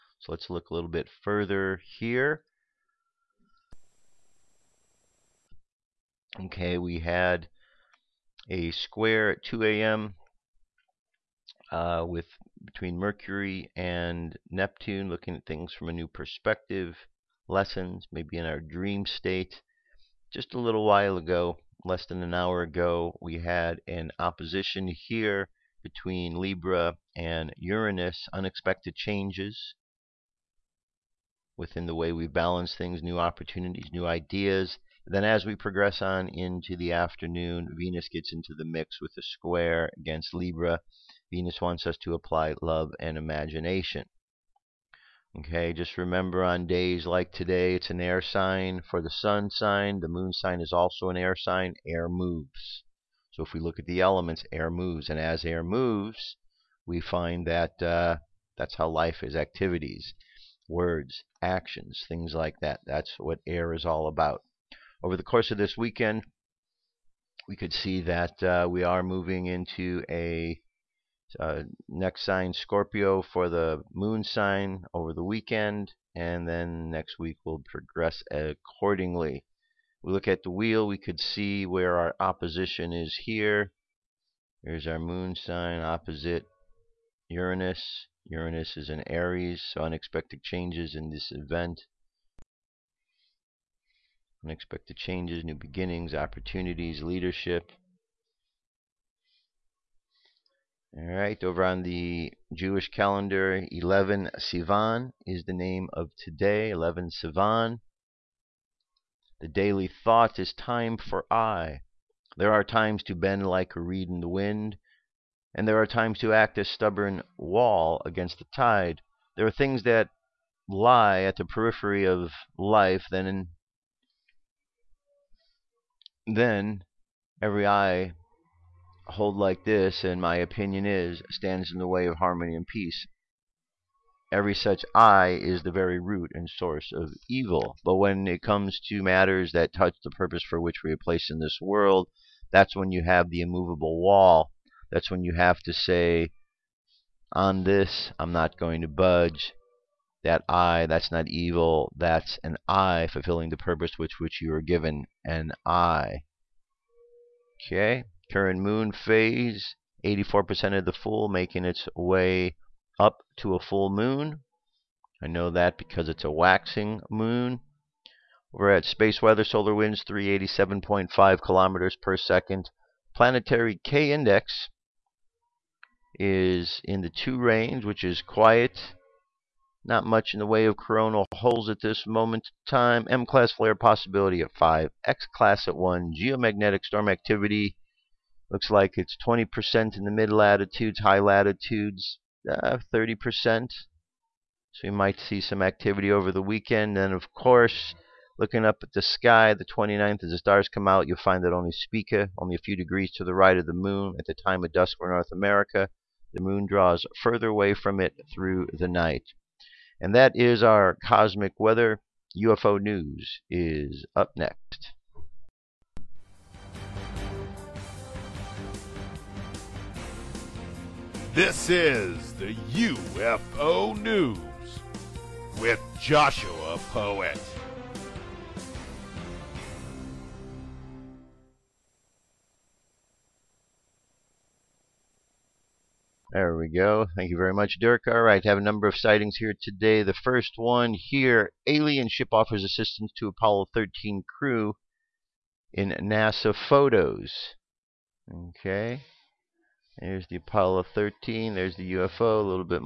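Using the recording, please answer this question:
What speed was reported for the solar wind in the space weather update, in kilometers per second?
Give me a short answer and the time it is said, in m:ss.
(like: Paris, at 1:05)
387.5, at 2:50.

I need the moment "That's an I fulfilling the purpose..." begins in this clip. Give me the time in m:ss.
2:31.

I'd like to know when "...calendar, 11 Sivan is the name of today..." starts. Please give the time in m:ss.
1:42.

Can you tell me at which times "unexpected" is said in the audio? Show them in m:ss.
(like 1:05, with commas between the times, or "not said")
0:28, 1:29, 1:34.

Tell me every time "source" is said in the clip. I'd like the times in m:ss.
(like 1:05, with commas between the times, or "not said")
2:16.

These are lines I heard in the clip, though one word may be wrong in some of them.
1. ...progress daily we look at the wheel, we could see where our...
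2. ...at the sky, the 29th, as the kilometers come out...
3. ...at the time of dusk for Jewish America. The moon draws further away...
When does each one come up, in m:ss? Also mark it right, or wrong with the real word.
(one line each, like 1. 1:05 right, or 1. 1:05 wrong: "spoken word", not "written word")
1. 1:17 wrong: "accordingly", not "daily"
2. 3:18 wrong: "stars", not "kilometers"
3. 3:24 wrong: "North", not "Jewish".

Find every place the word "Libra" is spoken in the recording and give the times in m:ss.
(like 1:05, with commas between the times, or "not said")
0:26, 0:40.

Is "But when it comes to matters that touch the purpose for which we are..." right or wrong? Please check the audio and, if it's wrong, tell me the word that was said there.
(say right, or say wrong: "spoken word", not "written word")
right.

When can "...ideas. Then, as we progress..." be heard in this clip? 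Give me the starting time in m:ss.
0:34.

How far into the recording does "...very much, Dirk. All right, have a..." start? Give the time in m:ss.
3:57.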